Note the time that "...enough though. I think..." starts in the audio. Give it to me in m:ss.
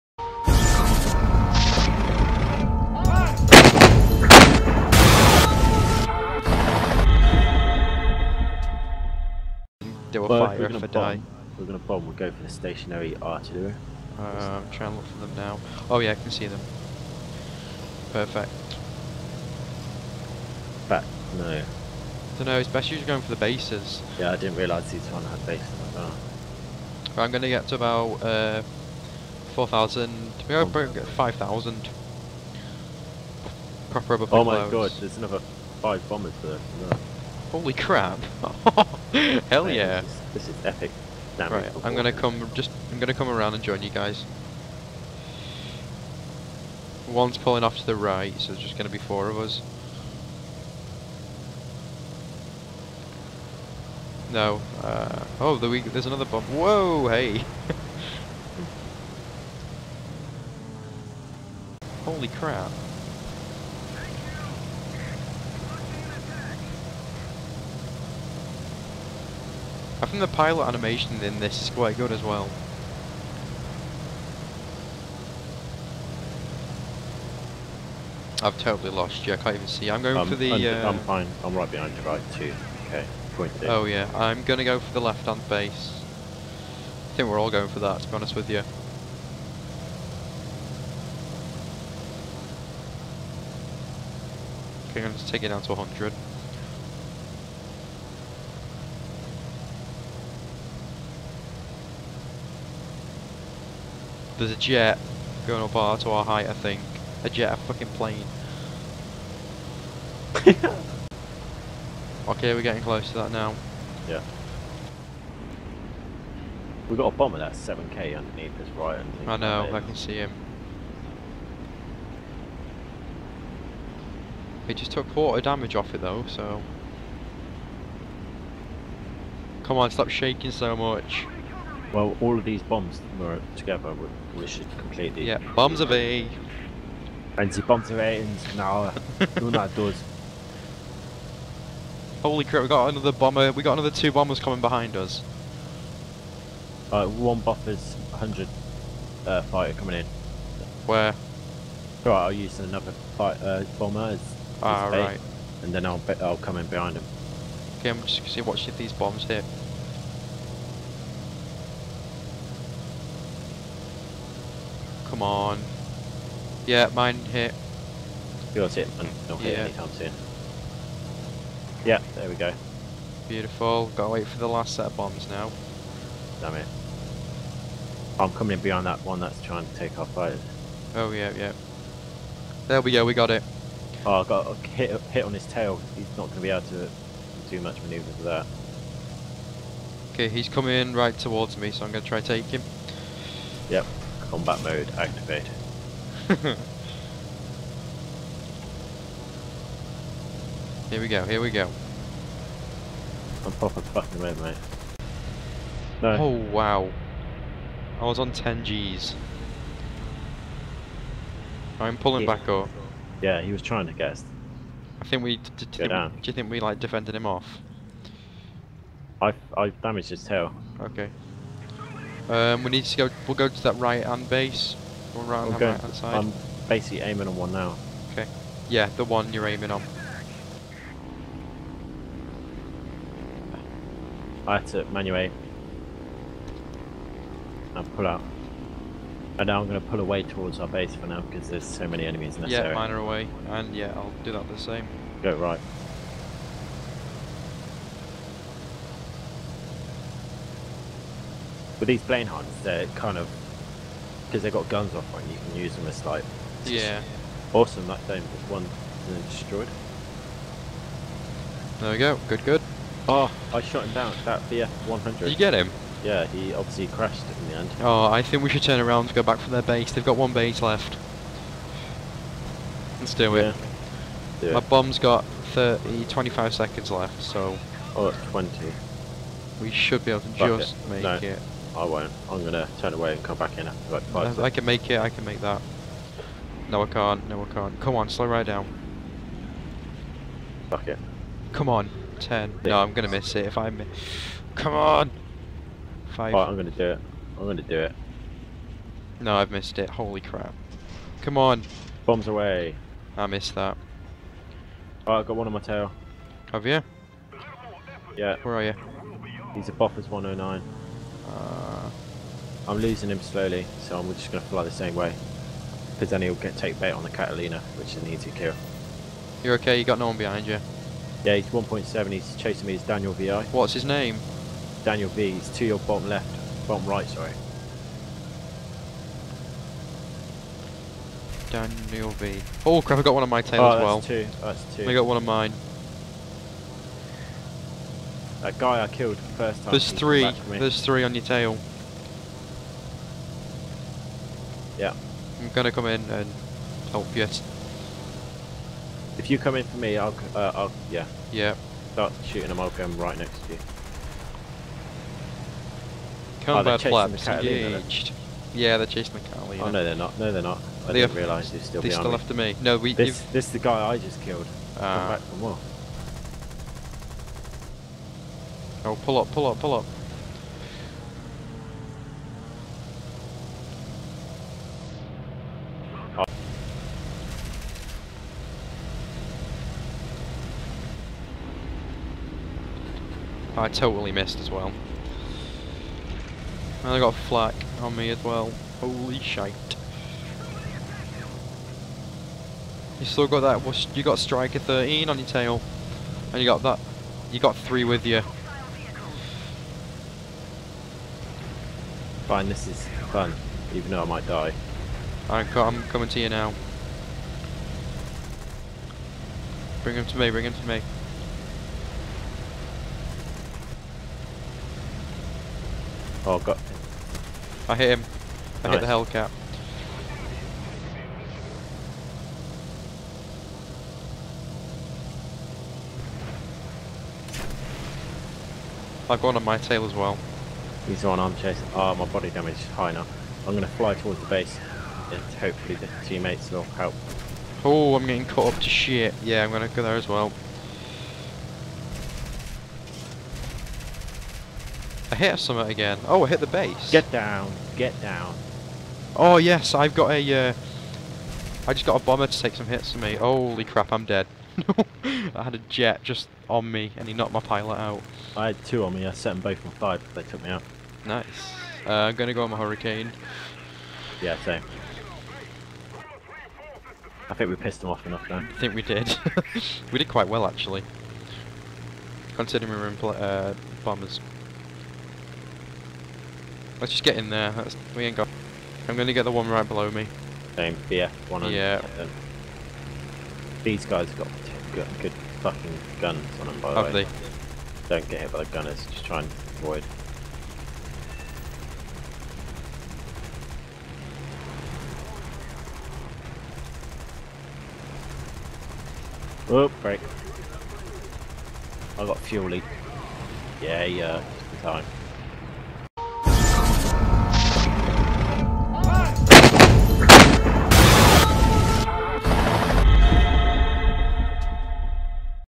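7:48.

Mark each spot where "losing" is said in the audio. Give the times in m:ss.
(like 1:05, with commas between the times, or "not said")
5:12.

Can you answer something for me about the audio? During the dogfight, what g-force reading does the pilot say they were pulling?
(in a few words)
10 Gs.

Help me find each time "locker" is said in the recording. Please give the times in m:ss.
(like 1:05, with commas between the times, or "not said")
not said.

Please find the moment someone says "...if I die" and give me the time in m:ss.
0:10.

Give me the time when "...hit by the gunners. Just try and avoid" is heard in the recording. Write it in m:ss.
8:08.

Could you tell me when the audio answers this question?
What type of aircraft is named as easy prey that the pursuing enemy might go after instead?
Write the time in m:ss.
5:17.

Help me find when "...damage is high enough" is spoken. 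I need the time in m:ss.
7:12.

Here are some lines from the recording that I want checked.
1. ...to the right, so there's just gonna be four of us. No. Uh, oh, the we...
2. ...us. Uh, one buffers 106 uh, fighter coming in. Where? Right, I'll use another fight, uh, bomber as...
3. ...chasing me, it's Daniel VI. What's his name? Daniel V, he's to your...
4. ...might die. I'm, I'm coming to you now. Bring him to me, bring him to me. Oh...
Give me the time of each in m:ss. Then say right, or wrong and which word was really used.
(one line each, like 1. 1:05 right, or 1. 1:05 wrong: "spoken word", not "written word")
1. 0:47 right
2. 2:24 wrong: "100", not "106"
3. 5:22 right
4. 6:44 right.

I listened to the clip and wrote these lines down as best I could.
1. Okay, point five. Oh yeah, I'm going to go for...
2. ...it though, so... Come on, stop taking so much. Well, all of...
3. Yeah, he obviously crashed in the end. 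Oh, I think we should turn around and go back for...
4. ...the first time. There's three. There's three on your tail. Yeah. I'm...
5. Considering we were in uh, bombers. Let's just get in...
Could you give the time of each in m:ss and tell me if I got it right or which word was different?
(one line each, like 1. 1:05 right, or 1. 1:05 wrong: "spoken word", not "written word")
1. 1:22 wrong: "two", not "five"
2. 2:05 wrong: "shaking", not "taking"
3. 4:26 right
4. 5:39 right
5. 7:52 right.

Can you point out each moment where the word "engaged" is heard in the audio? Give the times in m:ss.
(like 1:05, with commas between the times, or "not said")
5:57.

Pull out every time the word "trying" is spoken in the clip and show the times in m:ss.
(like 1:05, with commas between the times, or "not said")
0:14, 2:59, 3:33.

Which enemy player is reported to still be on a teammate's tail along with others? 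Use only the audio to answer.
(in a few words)
striker 13.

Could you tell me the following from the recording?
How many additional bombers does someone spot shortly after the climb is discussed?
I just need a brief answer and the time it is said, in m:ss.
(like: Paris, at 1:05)
5, at 0:35.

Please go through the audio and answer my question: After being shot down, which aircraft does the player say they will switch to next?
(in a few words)
Hurricane.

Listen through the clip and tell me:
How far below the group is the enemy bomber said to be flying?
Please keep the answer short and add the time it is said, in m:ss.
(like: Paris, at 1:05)
7k, at 1:57.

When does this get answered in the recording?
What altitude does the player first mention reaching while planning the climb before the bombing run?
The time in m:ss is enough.
0:29.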